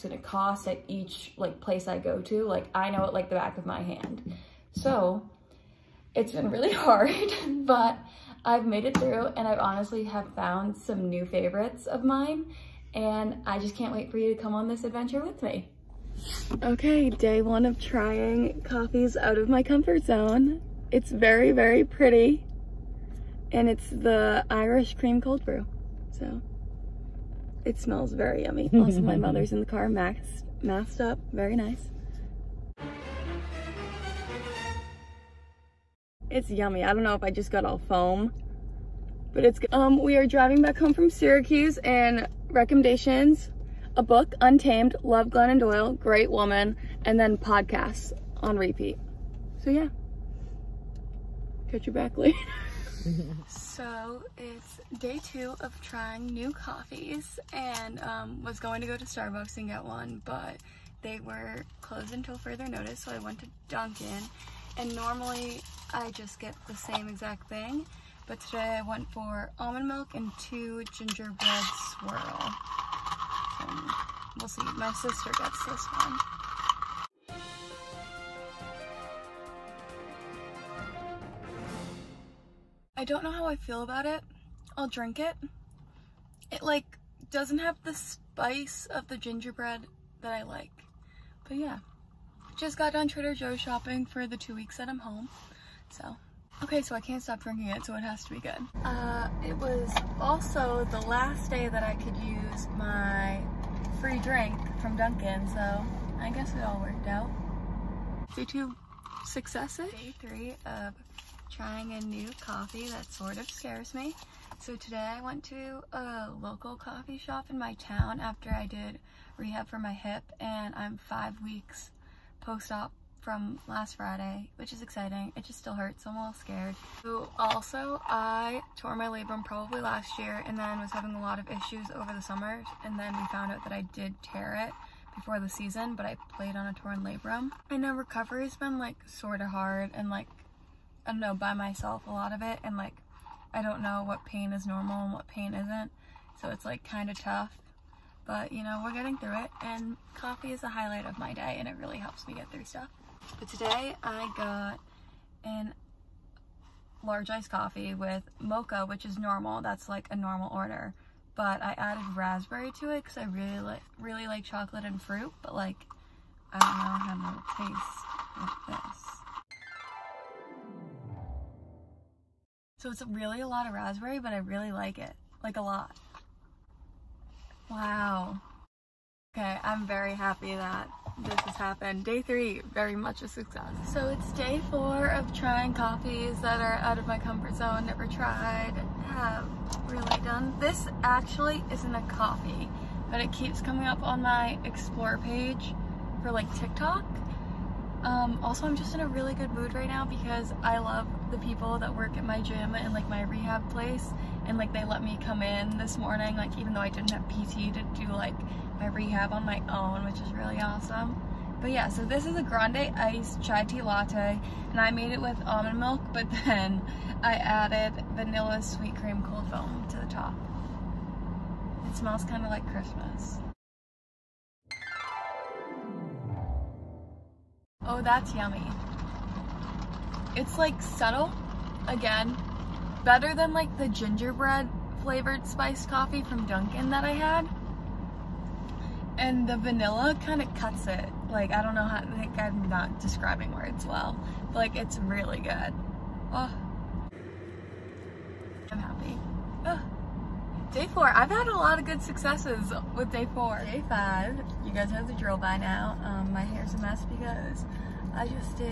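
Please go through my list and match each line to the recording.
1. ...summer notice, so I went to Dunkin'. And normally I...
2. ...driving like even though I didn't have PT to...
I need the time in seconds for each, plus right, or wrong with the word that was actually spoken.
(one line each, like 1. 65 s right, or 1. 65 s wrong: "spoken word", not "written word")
1. 62 s wrong: "further", not "summer"
2. 205 s wrong: "morning", not "driving".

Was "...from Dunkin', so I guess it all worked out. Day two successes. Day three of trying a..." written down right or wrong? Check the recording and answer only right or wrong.
right.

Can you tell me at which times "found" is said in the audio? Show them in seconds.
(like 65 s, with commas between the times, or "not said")
10 s, 133 s.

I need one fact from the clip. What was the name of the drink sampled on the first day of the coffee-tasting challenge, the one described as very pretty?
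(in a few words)
Irish cream cold brew.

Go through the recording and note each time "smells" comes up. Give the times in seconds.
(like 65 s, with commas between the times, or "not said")
27 s, 221 s.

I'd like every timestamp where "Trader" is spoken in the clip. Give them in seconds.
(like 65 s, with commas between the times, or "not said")
93 s.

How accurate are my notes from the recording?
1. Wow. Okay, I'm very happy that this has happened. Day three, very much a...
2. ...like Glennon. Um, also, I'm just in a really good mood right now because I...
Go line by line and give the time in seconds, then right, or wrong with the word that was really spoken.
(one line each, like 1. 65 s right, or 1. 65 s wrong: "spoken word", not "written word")
1. 177 s right
2. 196 s wrong: "TikTok", not "Glennon".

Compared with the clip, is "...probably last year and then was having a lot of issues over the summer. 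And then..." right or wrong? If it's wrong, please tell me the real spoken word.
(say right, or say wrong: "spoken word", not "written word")
right.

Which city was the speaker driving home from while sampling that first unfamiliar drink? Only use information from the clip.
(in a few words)
Syracuse.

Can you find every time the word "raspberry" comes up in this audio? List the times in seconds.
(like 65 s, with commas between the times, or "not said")
162 s, 173 s.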